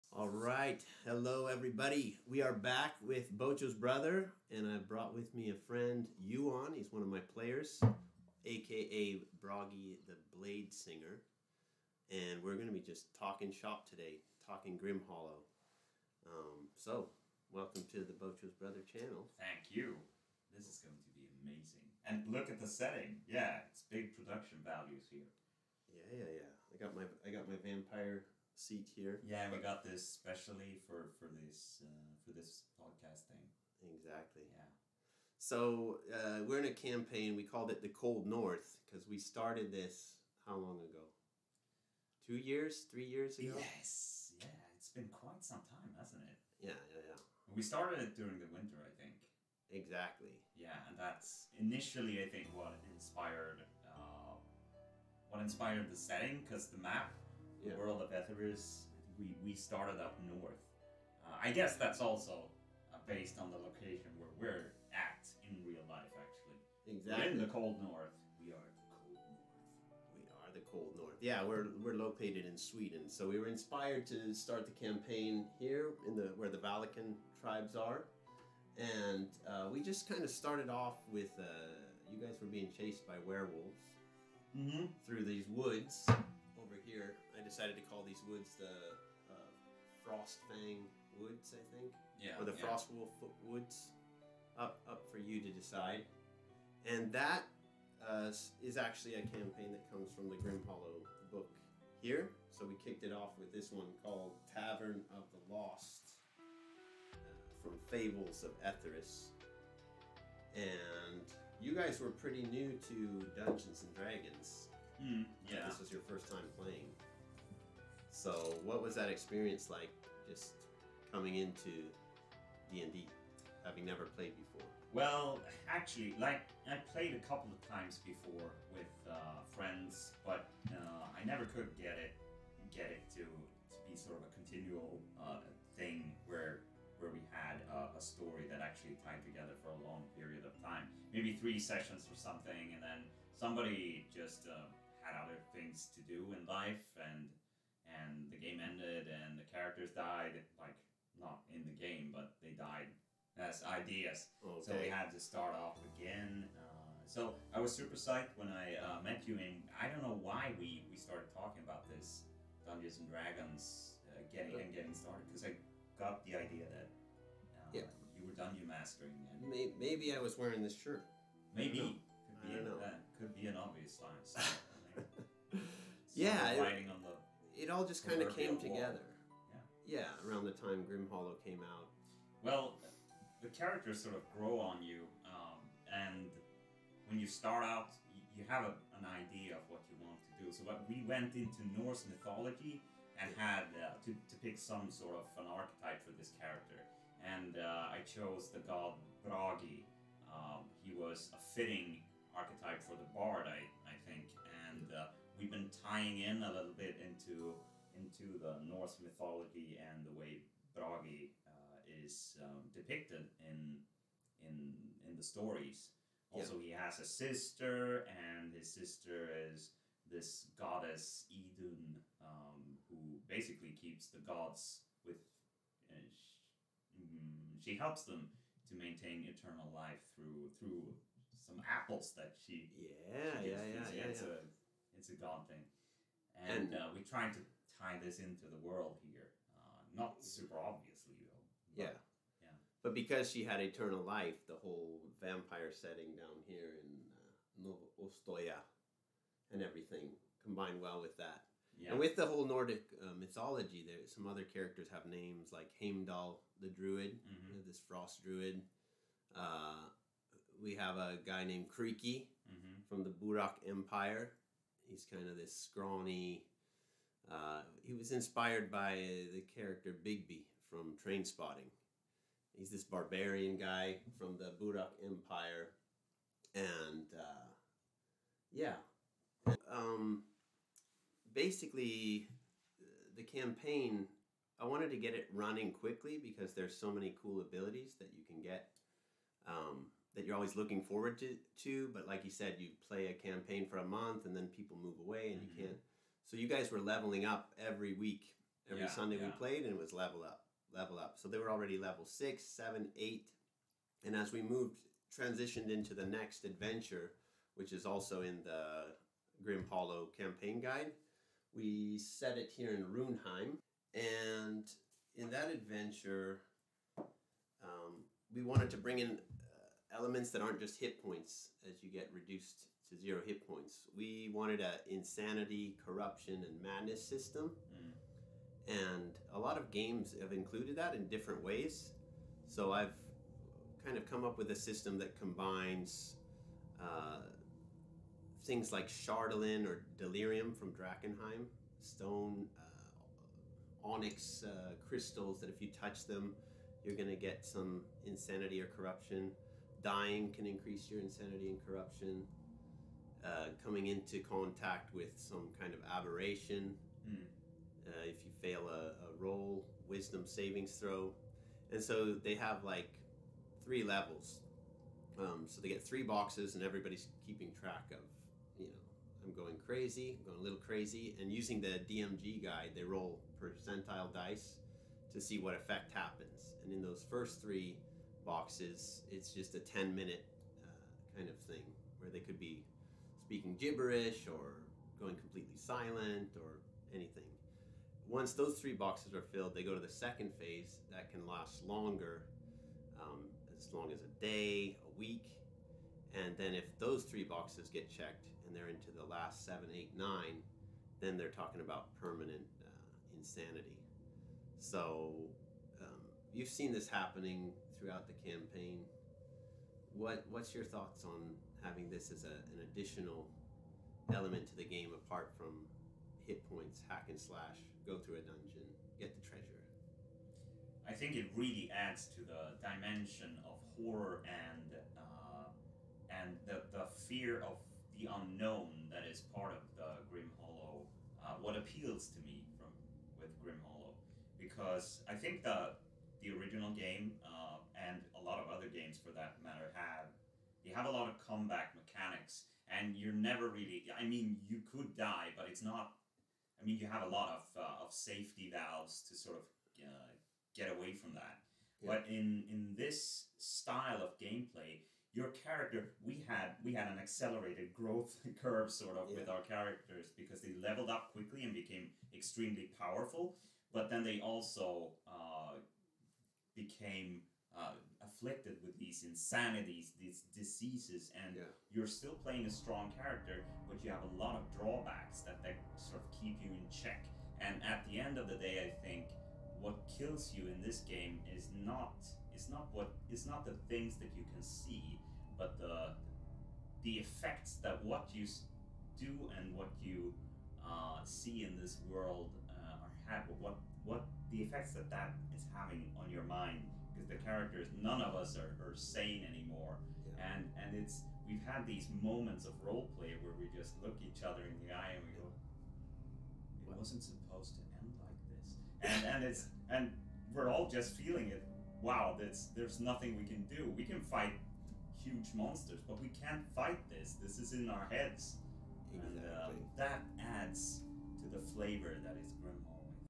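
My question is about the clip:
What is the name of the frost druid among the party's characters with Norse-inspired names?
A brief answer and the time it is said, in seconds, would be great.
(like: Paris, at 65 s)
Heimdall, at 255 s.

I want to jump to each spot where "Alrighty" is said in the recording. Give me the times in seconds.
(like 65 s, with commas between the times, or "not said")
not said.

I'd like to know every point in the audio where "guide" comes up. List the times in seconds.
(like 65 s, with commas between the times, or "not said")
310 s, 372 s.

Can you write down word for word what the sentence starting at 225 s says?
Uh, mm, she, helps them to maintain eternal life through through some apples that she.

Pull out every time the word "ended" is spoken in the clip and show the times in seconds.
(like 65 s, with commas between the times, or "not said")
148 s.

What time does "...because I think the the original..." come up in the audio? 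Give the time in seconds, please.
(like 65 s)
434 s.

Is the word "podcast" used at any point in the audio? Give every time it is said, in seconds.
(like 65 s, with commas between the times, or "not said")
32 s.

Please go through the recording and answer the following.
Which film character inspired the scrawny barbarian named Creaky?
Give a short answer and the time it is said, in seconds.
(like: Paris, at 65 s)
Begbie, at 270 s.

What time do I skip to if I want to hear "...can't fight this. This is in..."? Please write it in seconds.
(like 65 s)
516 s.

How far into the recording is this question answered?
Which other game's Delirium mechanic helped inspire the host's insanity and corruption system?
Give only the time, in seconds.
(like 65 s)
340 s.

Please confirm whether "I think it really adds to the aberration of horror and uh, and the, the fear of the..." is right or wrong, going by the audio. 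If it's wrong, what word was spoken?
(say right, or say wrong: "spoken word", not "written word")
wrong: "dimension", not "aberration".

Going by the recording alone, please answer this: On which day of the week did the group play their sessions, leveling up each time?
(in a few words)
Sunday.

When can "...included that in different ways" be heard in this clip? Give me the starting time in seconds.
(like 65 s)
330 s.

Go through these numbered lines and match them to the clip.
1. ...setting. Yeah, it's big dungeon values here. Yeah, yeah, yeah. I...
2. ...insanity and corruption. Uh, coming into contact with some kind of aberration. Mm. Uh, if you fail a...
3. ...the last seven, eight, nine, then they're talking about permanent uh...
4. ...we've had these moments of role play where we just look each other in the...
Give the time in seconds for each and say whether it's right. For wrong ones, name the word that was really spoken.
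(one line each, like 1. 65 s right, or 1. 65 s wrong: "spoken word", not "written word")
1. 22 s wrong: "production", not "dungeon"
2. 351 s right
3. 398 s right
4. 501 s right.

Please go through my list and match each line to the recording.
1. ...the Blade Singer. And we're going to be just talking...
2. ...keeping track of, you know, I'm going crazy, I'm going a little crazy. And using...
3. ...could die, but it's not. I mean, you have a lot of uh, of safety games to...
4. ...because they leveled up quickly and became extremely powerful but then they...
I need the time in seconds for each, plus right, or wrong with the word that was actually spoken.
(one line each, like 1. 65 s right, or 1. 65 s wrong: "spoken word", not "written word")
1. 10 s right
2. 367 s right
3. 444 s wrong: "valves", not "games"
4. 460 s right.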